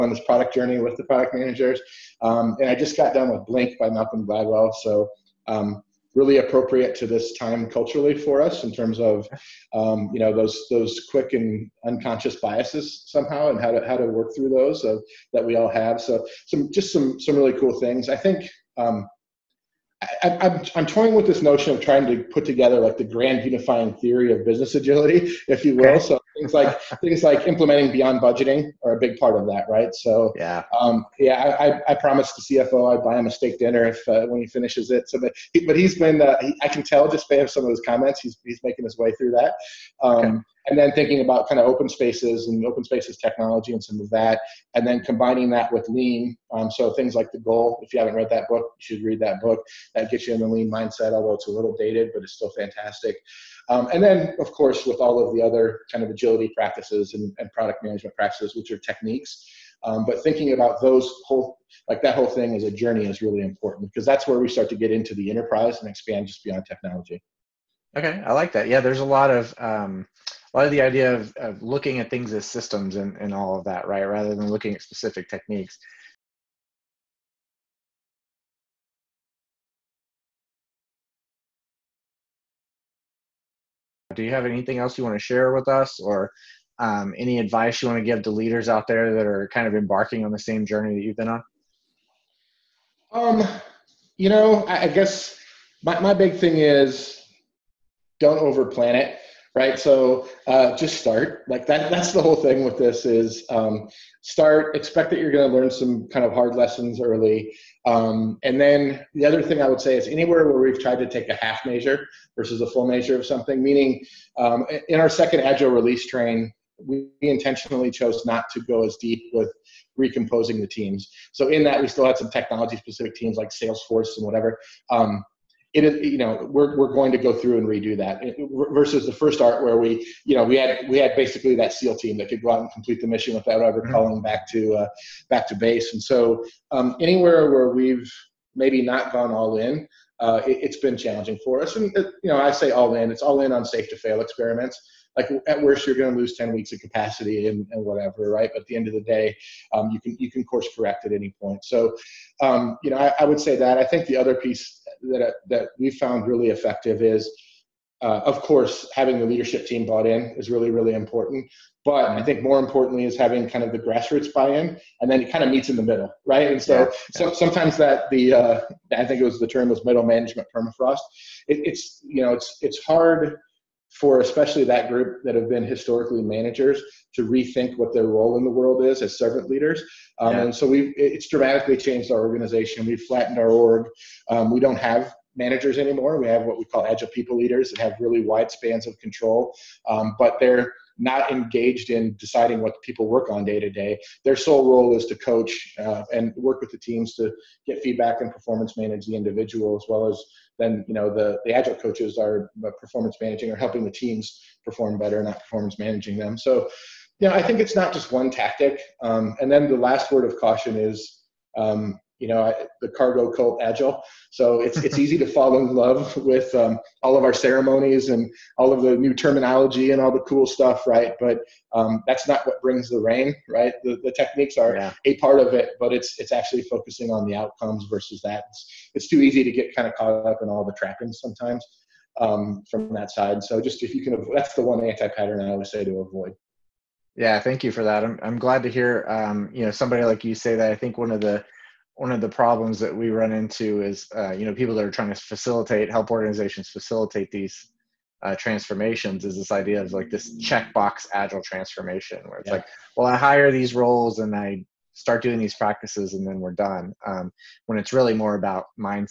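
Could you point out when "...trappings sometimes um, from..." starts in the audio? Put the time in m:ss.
3:50.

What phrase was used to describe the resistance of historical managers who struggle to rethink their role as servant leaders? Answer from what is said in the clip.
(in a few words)
Middle management permafrost.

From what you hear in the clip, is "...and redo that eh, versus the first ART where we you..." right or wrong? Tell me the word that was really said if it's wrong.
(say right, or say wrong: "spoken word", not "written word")
right.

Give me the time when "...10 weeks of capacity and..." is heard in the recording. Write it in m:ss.
2:26.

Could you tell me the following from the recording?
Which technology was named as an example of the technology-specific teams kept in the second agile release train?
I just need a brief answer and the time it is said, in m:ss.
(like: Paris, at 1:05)
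Salesforce, at 2:03.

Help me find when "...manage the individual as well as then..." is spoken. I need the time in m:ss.
3:18.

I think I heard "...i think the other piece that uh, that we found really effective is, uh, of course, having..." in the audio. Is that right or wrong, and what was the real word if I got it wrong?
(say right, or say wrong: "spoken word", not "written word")
right.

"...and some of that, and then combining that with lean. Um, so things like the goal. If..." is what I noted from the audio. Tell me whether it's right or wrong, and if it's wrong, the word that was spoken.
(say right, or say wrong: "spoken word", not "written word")
right.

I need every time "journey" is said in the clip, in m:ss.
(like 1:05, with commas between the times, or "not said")
0:00, 1:02, 1:30.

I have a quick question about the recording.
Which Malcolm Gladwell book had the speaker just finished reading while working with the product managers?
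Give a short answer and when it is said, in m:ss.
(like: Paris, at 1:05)
Blink, at 0:03.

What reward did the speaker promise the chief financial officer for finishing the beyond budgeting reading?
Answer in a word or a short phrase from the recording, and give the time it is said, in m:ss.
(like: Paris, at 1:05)
A steak dinner, at 0:33.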